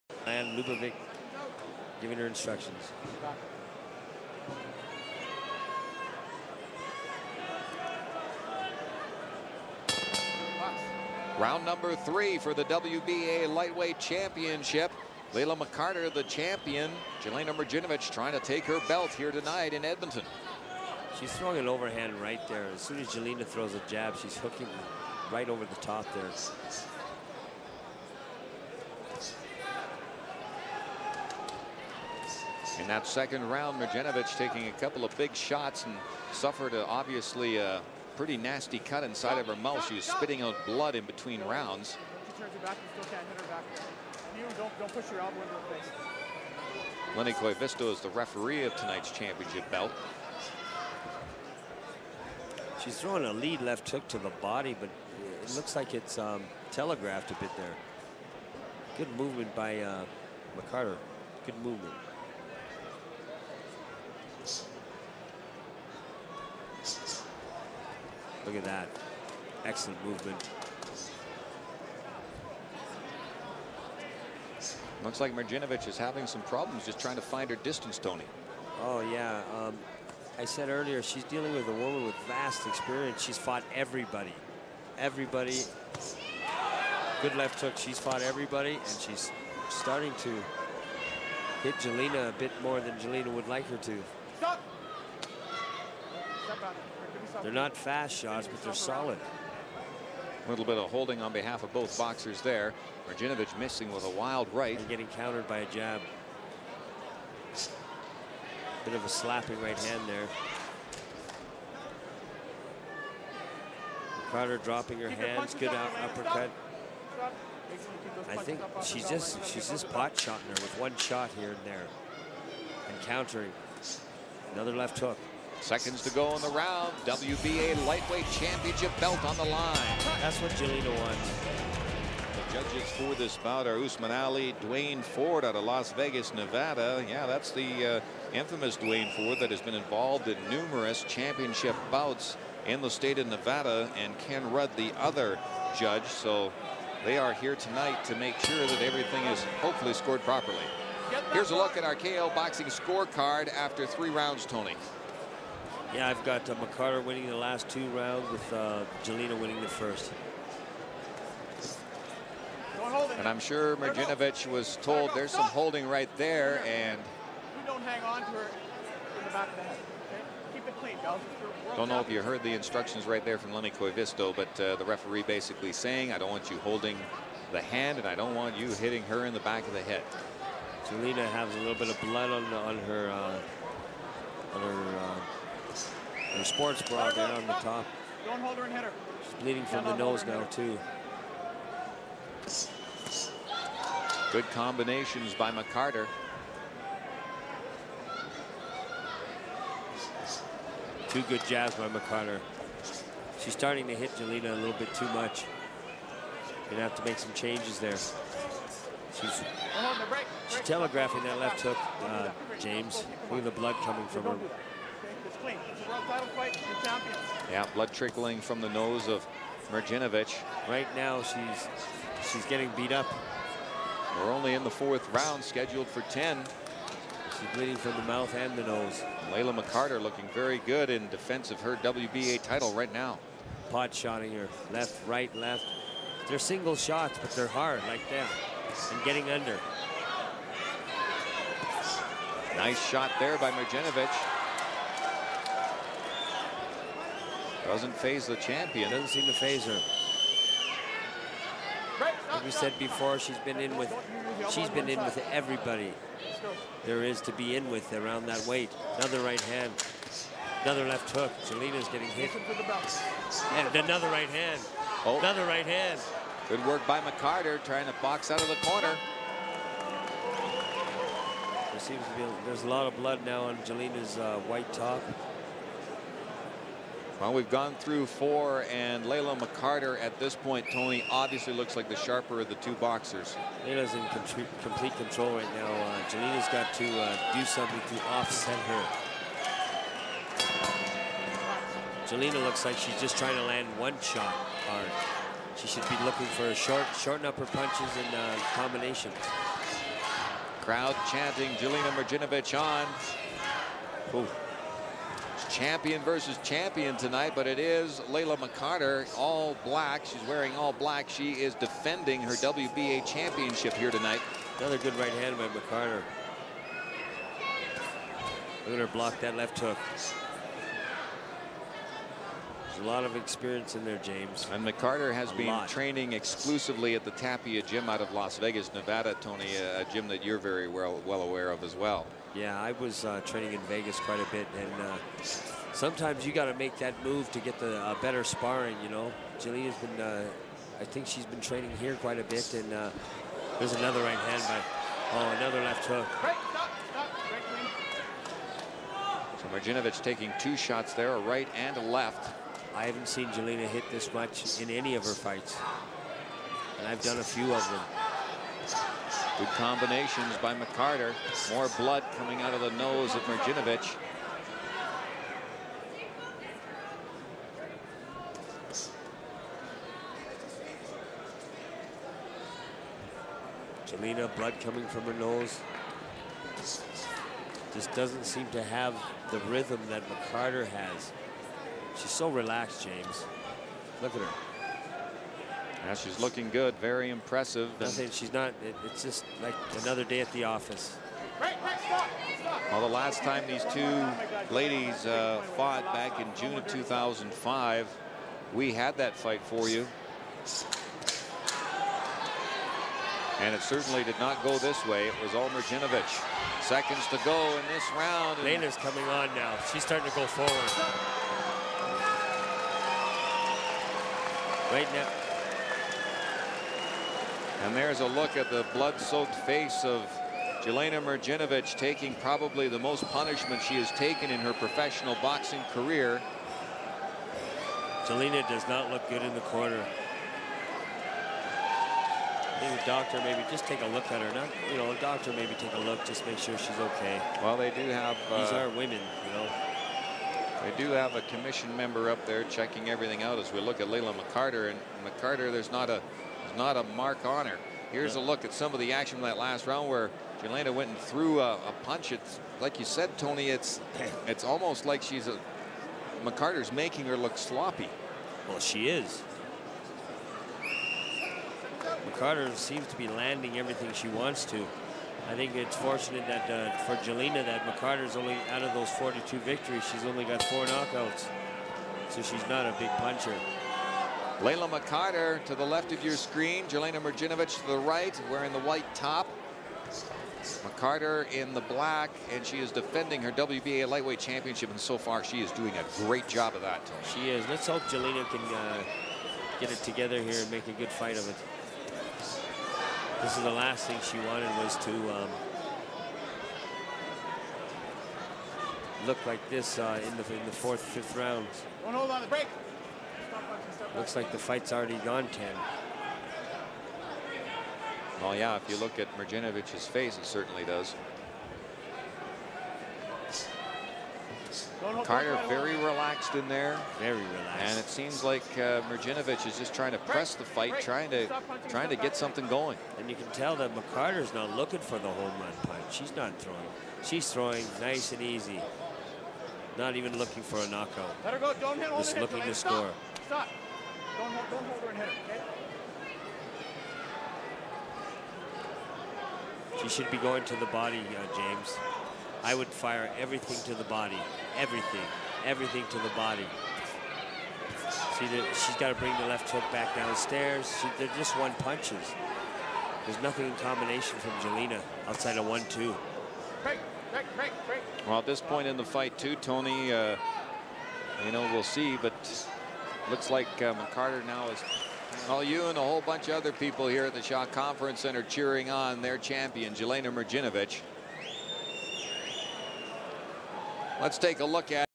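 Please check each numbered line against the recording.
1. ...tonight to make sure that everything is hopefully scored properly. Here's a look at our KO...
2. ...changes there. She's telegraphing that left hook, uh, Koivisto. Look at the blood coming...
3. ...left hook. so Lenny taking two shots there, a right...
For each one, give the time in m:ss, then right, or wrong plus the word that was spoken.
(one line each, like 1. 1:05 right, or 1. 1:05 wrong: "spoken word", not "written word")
1. 2:27 right
2. 3:27 wrong: "James", not "Koivisto"
3. 5:45 wrong: "Mrdjenovich", not "Lenny".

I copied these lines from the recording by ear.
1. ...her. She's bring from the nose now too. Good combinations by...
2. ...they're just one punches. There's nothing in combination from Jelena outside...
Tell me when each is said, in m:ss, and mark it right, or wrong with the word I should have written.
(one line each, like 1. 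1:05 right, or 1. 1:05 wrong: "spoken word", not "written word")
1. 3:08 wrong: "bleeding", not "bring"
2. 9:10 right.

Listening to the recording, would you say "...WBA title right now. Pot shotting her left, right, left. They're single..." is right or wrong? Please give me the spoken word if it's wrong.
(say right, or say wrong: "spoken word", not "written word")
right.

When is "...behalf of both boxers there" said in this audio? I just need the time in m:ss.
1:41.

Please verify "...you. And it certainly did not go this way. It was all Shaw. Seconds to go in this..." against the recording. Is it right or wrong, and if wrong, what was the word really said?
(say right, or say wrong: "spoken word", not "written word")
wrong: "Mrdjenovich", not "Shaw".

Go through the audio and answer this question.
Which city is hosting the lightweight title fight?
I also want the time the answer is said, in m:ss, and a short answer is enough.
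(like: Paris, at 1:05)
Edmonton, at 0:19.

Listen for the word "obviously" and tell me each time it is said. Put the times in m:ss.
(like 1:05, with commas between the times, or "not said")
0:36, 4:41.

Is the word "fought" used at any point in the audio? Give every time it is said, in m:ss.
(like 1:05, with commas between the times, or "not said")
1:23, 1:27, 6:35.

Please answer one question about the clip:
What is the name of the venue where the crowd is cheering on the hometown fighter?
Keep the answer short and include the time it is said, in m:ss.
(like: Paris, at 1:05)
Shaw Conference Center, at 9:27.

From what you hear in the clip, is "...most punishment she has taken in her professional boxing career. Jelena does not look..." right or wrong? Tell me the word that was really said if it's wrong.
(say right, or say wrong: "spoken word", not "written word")
right.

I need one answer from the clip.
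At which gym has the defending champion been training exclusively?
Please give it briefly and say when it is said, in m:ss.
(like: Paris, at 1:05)
Tapia gym, at 5:27.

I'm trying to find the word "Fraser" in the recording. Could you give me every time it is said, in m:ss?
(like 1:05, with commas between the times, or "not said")
not said.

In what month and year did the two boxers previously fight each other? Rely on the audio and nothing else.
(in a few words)
June 2005.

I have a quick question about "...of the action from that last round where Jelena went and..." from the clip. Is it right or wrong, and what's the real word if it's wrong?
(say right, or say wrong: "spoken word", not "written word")
right.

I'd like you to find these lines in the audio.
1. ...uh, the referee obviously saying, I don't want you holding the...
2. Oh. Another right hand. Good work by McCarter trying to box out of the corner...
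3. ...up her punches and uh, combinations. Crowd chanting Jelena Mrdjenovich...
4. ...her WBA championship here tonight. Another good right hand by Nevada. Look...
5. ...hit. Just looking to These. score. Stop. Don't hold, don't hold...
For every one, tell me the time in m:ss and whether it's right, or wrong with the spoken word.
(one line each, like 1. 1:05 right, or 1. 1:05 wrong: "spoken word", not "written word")
1. 2:54 wrong: "basically", not "obviously"
2. 4:25 right
3. 4:57 right
4. 5:12 wrong: "McCarter", not "Nevada"
5. 8:51 wrong: "Stop", not "These".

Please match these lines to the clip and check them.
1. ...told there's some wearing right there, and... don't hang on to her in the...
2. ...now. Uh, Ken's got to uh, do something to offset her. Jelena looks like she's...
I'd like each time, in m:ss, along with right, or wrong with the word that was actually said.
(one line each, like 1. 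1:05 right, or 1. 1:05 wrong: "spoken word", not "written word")
1. 2:44 wrong: "holding", not "wearing"
2. 4:45 wrong: "Jelena", not "Ken".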